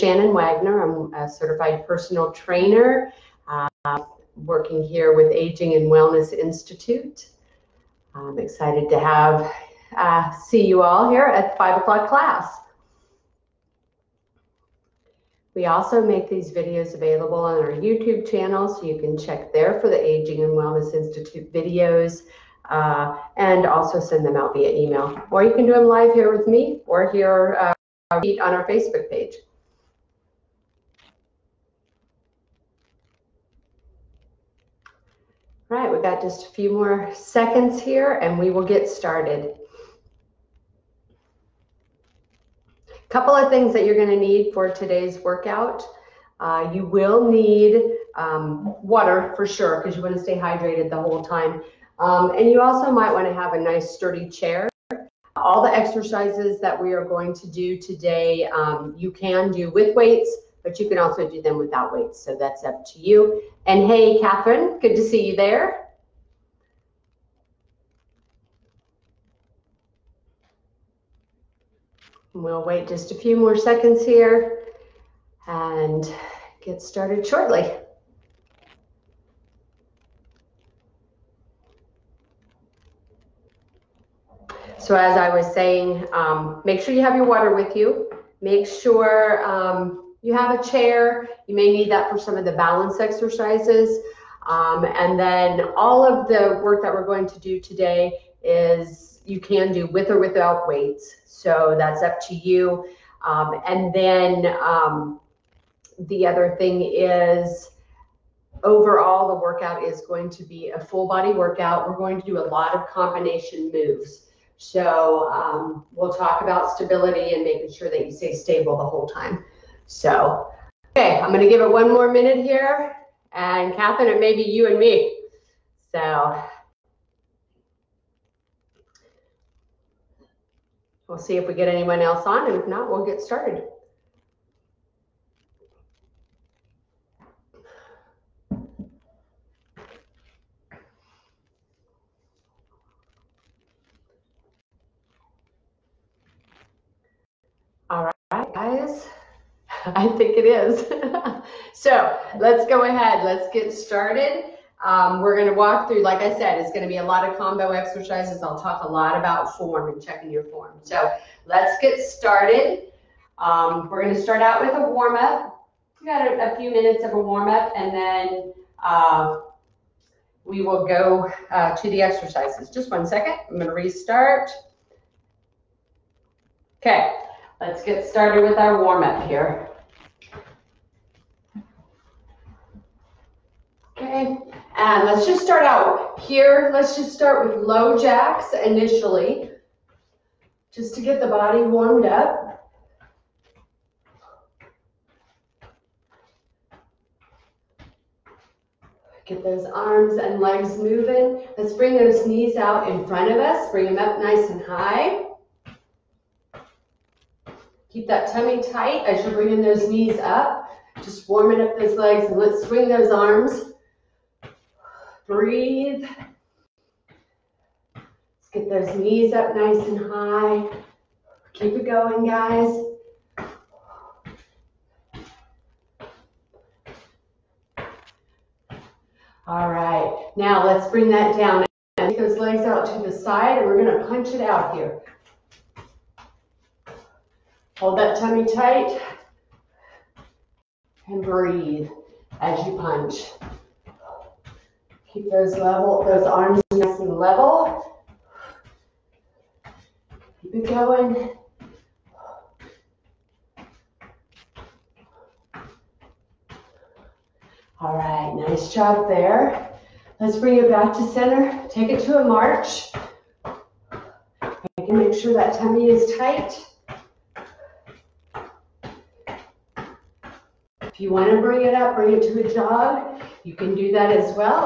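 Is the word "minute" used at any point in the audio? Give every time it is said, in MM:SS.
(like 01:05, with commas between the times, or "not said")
02:02, 02:46.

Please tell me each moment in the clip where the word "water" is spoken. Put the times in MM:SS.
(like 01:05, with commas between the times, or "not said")
00:48, 01:27.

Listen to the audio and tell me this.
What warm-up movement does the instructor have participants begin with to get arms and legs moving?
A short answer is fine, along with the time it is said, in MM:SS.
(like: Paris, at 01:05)
Low jacks, at 03:07.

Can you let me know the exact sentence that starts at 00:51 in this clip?
Um, and you also might want to have a nice sturdy chair.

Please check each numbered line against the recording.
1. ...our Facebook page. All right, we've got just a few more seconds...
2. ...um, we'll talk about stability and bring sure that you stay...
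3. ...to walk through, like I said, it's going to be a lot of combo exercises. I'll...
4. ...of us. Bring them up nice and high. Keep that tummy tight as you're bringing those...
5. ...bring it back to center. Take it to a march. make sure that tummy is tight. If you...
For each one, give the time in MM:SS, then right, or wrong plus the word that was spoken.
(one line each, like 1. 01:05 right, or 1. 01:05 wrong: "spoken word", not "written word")
1. 00:28 right
2. 01:55 wrong: "making", not "bring"
3. 02:35 right
4. 03:23 right
5. 04:20 right.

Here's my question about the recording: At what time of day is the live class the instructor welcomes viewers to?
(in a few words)
5 o'clock.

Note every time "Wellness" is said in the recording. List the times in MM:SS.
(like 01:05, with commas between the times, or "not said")
00:05, 00:20.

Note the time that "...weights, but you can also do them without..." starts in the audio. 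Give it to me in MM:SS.
00:59.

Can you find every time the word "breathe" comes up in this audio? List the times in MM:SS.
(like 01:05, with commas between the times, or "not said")
03:35, 04:01.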